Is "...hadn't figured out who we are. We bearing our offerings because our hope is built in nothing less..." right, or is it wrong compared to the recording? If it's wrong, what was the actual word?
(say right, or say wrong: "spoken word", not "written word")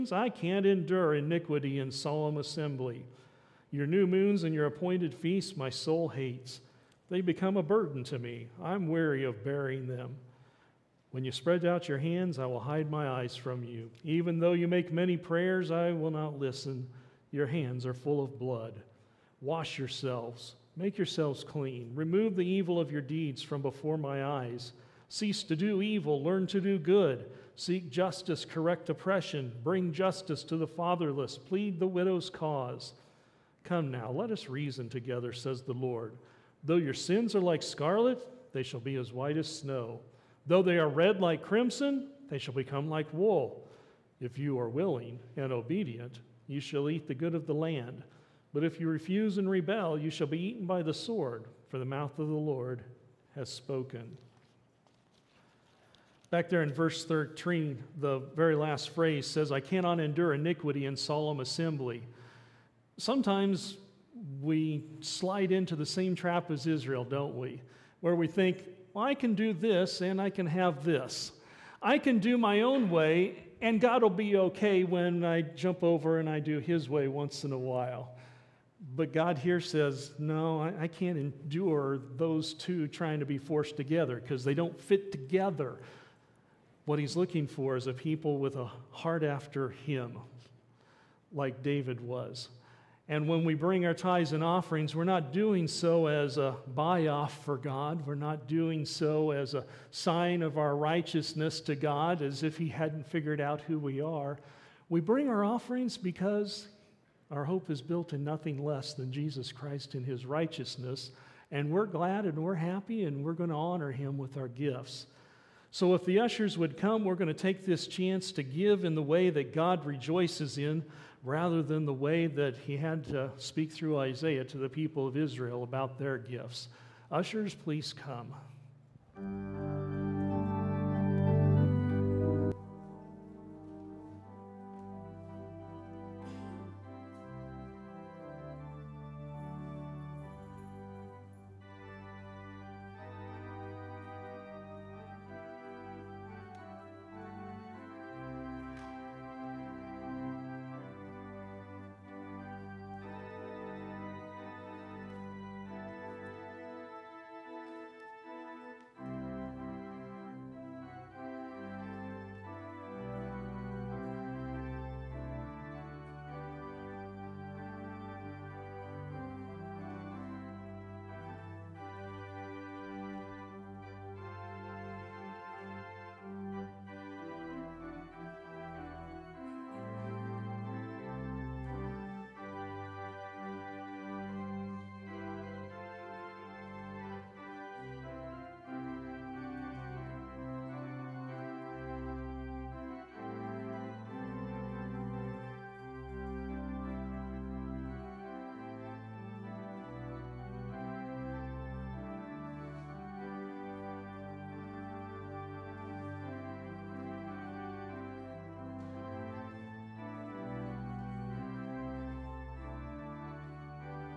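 wrong: "bring", not "bearing".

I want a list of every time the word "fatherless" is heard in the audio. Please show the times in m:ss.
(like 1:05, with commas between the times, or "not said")
0:30.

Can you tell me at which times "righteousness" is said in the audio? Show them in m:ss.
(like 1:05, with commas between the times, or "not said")
1:40, 1:50.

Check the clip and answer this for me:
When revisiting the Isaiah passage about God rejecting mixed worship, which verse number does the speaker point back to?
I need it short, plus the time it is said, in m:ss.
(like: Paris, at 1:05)
13, at 0:57.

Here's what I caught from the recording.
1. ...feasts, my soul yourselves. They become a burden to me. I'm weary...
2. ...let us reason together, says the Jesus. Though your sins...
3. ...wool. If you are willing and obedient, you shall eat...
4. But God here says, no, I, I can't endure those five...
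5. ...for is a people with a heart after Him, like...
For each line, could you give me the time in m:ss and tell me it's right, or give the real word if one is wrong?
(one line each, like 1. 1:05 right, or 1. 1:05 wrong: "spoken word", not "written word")
1. 0:05 wrong: "hates", not "yourselves"
2. 0:34 wrong: "Lord", not "Jesus"
3. 0:43 right
4. 1:18 wrong: "two", not "five"
5. 1:27 right.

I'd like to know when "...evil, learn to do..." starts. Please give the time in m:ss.
0:25.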